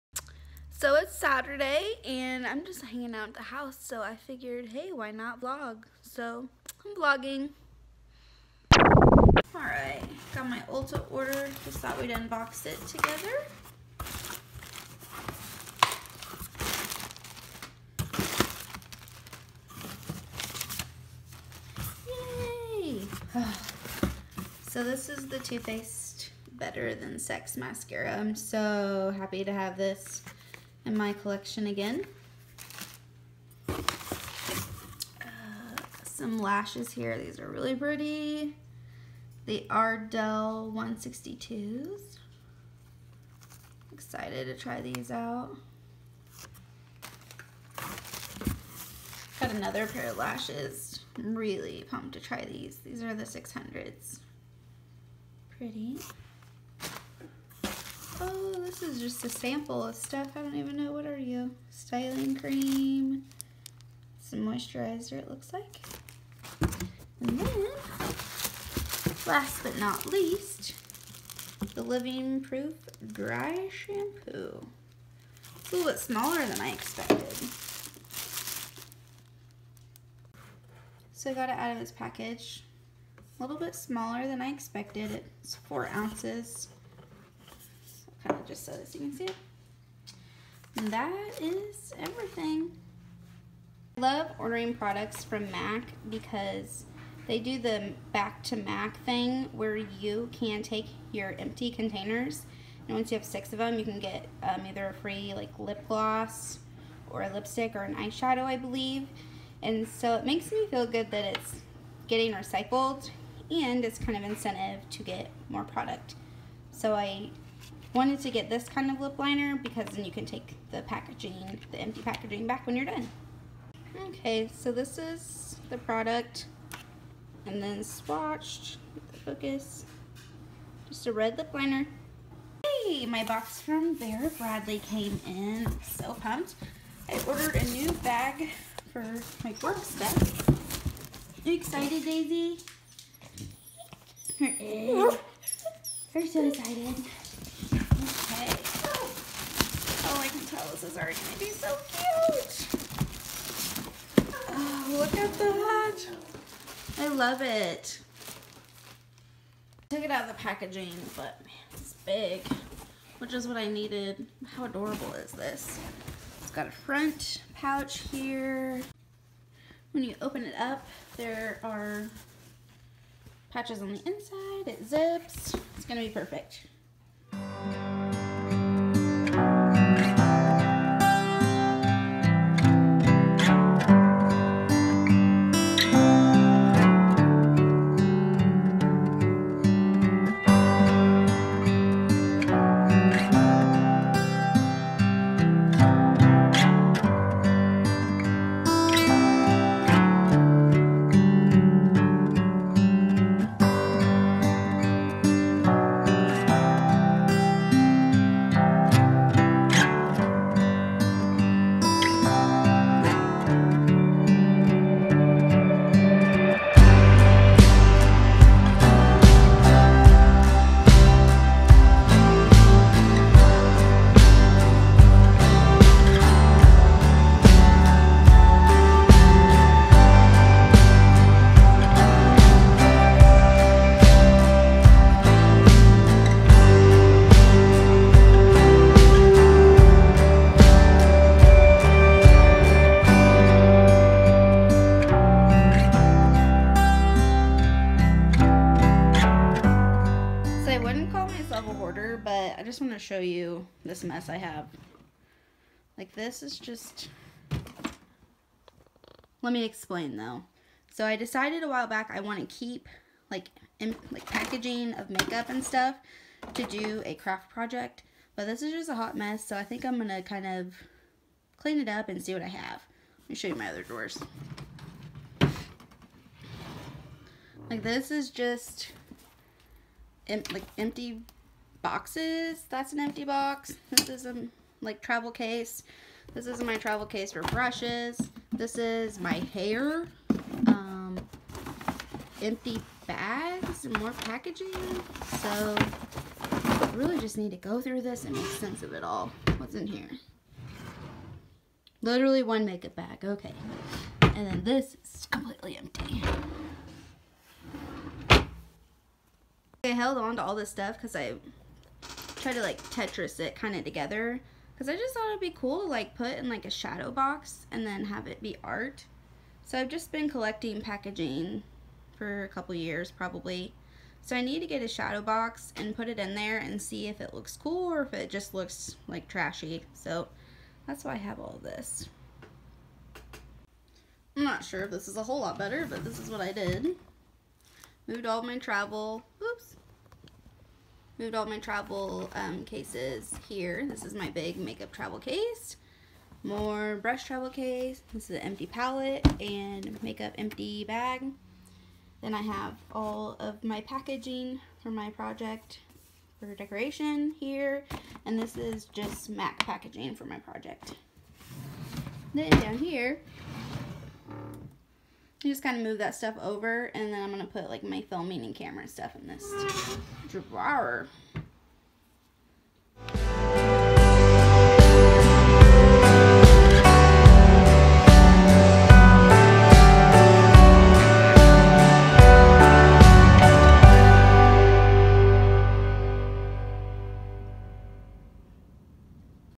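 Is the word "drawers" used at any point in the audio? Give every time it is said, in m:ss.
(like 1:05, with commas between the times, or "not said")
4:33, 6:10.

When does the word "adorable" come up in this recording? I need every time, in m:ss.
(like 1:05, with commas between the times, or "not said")
2:44.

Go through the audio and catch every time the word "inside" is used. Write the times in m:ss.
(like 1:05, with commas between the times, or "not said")
2:54.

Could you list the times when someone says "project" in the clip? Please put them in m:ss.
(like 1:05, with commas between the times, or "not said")
4:27, 5:55, 6:00.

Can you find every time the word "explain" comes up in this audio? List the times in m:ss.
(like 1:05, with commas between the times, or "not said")
4:19.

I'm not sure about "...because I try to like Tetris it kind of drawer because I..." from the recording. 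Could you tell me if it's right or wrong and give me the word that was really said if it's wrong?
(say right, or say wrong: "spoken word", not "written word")
wrong: "together", not "drawer".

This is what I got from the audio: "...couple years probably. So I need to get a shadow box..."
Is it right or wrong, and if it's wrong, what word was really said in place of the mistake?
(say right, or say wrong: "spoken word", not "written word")
right.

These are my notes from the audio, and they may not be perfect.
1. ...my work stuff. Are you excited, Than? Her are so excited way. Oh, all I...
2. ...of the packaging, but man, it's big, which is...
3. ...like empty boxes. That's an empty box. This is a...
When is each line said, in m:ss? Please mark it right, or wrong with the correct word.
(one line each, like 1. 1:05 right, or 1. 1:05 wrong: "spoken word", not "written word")
1. 2:19 wrong: "Daisy", not "Than"
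2. 2:40 right
3. 4:40 right.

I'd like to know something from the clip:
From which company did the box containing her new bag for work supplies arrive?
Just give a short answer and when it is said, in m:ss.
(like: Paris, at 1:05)
Vera Bradley, at 2:13.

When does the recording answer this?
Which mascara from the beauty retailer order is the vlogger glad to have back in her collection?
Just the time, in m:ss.
0:26.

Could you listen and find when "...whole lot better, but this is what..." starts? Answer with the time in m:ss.
5:35.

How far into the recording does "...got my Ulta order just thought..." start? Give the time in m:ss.
0:10.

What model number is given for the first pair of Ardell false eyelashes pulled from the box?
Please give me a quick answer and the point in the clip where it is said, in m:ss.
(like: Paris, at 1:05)
162, at 0:40.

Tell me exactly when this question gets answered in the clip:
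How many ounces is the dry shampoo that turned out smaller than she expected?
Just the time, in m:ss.
1:25.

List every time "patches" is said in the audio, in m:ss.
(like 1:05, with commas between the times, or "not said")
2:53.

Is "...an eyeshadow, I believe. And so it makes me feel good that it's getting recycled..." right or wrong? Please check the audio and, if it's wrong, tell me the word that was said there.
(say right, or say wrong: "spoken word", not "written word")
right.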